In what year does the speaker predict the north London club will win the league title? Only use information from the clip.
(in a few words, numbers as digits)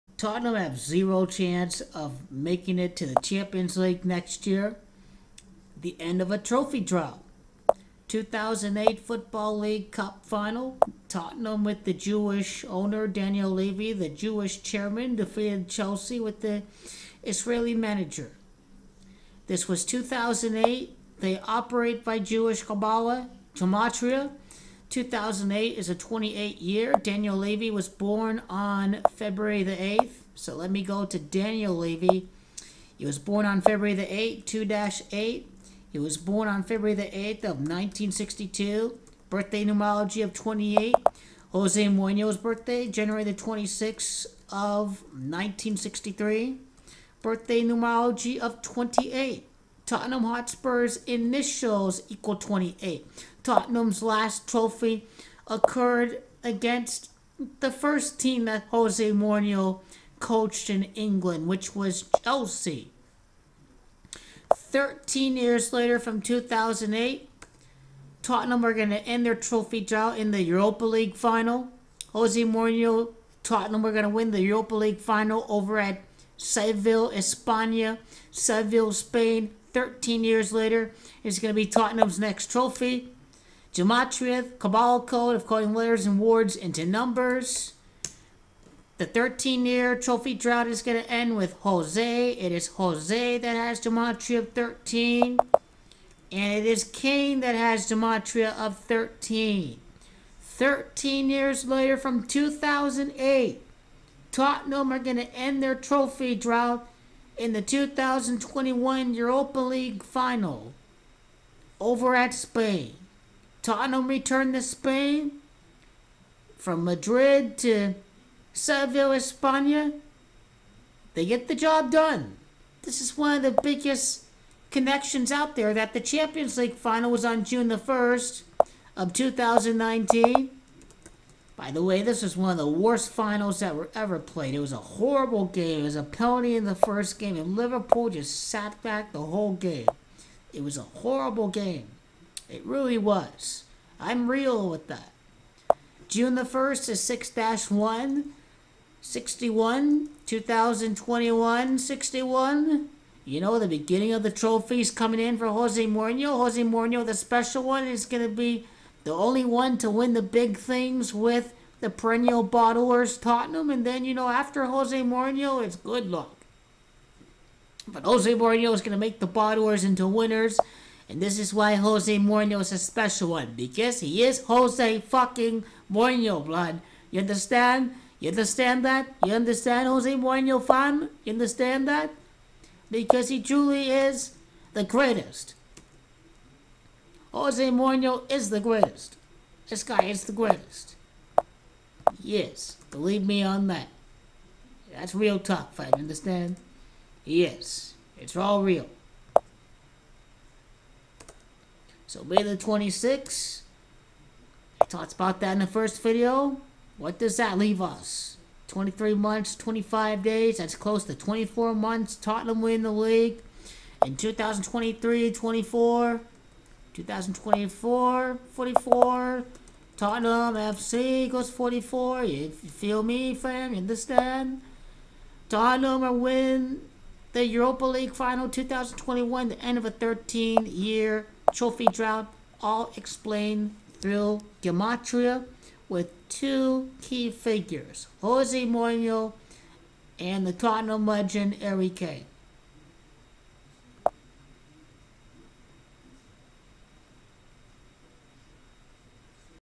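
2024.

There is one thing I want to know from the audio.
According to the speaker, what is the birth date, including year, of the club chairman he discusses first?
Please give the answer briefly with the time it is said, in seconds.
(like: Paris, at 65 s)
February 8, 1962, at 36 s.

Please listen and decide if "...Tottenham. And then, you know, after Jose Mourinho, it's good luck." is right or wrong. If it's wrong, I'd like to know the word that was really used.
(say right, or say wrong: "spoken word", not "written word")
right.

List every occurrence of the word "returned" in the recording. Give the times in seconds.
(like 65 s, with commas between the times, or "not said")
114 s.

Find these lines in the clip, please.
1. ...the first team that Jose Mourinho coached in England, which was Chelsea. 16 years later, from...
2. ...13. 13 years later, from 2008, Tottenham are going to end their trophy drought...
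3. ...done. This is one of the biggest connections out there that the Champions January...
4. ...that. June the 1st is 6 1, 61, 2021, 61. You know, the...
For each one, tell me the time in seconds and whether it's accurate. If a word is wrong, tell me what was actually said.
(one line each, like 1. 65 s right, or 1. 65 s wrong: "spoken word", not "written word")
1. 57 s wrong: "13", not "16"
2. 98 s right
3. 121 s wrong: "League", not "January"
4. 144 s right.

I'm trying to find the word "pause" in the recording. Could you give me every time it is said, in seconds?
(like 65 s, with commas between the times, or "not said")
not said.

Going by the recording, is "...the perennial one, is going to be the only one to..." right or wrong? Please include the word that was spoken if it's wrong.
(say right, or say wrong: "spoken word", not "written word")
wrong: "special", not "perennial".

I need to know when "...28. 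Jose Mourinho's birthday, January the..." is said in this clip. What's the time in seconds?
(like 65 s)
40 s.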